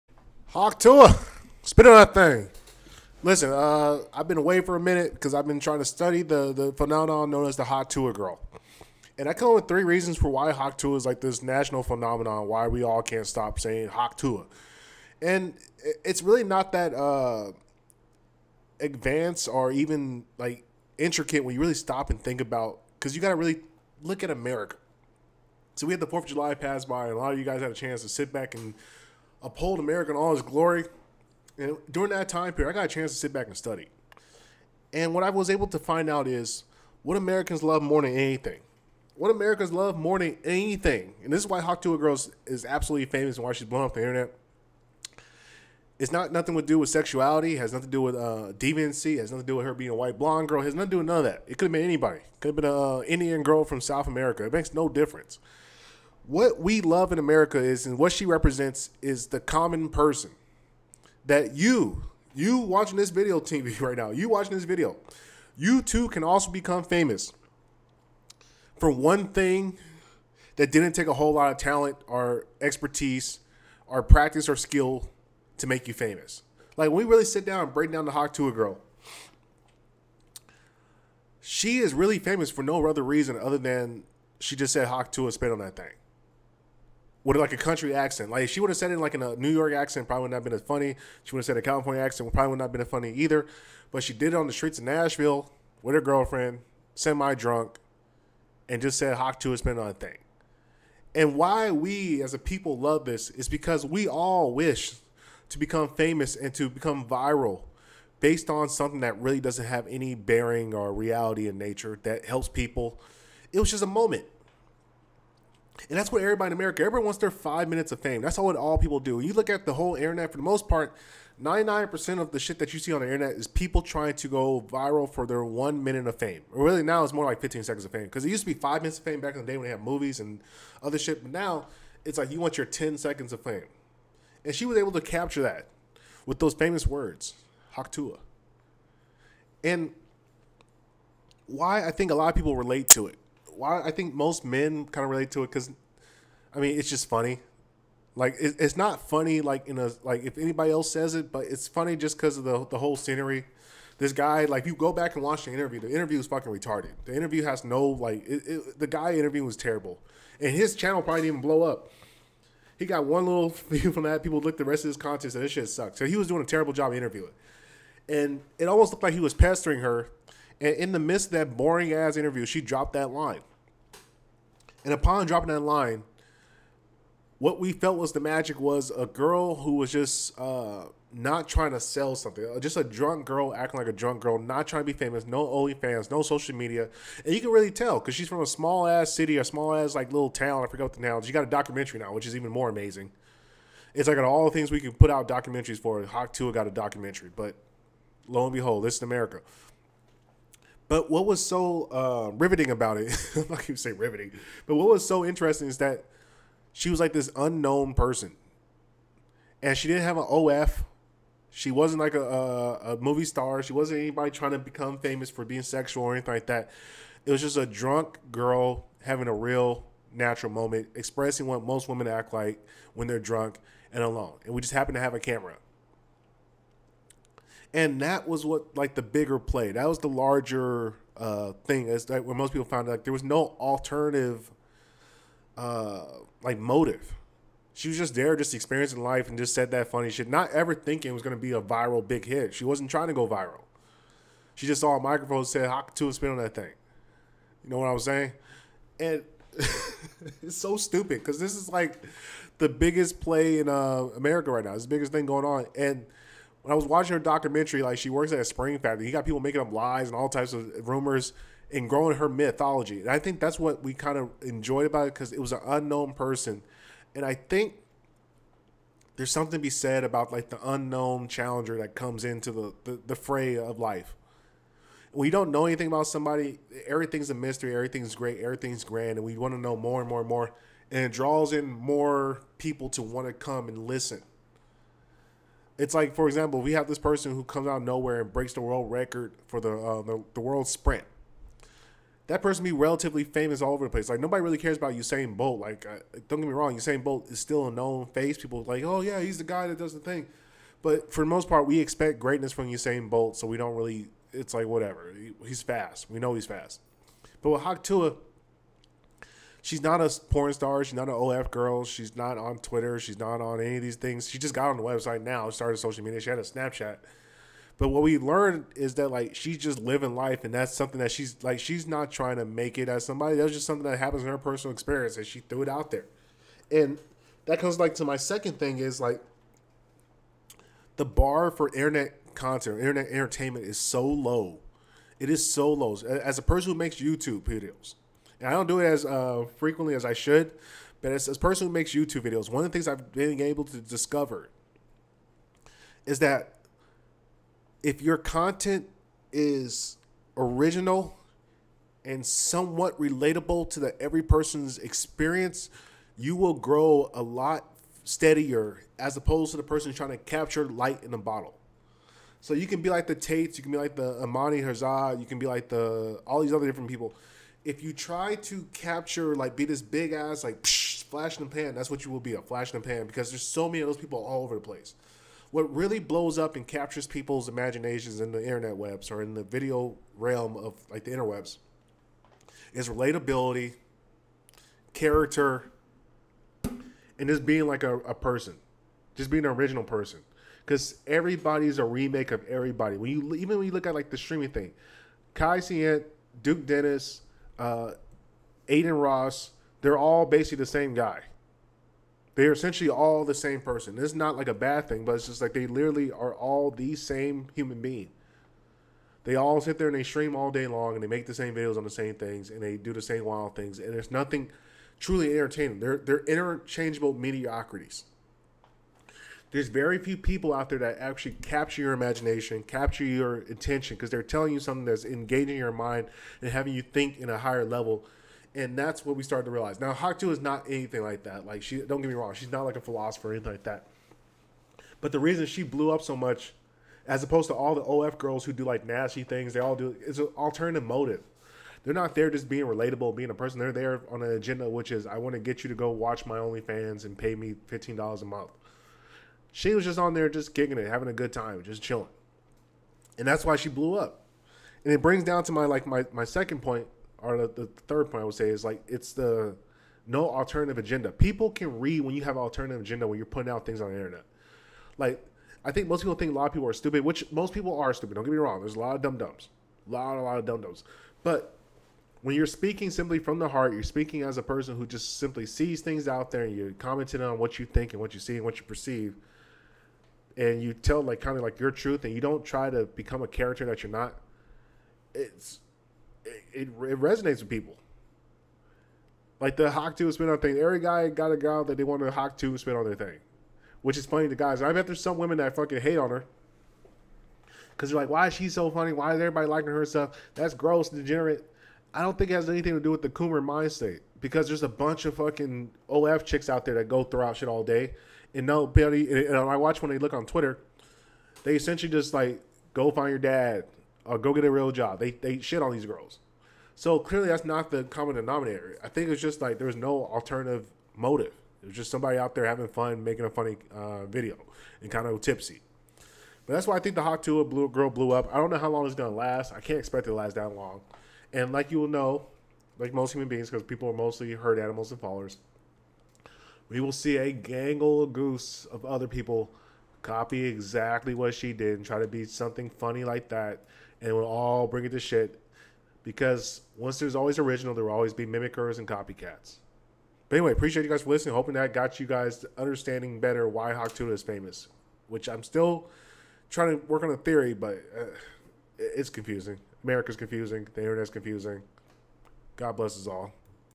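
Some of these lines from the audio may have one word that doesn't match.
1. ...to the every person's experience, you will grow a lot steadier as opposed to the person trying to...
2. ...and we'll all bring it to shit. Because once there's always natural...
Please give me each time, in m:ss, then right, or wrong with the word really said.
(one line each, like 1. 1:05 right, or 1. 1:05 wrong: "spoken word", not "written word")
1. 5:53 right
2. 9:04 wrong: "original", not "natural".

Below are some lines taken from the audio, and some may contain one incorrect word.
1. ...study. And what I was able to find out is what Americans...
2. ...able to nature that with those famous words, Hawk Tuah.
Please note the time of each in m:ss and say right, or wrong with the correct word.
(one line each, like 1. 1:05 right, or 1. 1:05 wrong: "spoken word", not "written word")
1. 0:33 right
2. 2:14 wrong: "capture", not "nature".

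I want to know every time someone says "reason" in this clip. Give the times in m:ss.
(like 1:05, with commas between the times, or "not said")
0:09, 1:23, 7:15.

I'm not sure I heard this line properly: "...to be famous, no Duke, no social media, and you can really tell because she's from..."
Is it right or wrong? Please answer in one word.
wrong.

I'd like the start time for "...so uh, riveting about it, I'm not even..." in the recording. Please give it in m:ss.
3:21.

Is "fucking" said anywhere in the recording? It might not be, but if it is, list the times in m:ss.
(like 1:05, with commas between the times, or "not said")
2:36, 8:15, 8:25.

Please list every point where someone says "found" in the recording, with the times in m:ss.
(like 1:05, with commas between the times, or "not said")
3:52.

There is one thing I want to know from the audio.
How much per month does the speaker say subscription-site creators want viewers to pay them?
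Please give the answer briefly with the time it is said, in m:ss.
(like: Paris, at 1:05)
$15, at 7:27.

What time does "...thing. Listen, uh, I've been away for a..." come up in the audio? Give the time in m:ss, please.
0:02.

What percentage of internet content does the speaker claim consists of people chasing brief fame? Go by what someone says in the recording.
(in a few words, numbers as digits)
99%.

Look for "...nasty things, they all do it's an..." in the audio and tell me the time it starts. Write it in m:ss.
7:18.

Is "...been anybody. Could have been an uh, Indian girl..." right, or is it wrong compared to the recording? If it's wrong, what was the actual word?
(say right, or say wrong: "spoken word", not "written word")
right.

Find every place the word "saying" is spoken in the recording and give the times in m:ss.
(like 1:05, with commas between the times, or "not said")
0:13, 4:08.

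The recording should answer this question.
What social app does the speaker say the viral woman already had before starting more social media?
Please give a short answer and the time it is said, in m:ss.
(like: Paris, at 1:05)
Snapchat, at 5:16.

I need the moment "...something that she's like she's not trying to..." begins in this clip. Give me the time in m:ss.
5:20.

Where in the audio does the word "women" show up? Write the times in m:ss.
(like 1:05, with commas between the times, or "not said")
3:41, 8:15.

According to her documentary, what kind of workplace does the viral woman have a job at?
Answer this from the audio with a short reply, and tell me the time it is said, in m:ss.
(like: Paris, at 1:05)
spring factory, at 4:18.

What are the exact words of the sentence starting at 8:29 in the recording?
And I watch when they look on Twitter, they essentially just like go find your dad or go get a real job.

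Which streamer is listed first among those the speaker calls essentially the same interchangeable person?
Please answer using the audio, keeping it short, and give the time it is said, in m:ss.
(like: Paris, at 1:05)
Kai Cenat, at 6:35.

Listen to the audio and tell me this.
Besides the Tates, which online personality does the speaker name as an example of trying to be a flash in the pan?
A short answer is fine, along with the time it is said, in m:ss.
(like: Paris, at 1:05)
Amani Herzog, at 6:04.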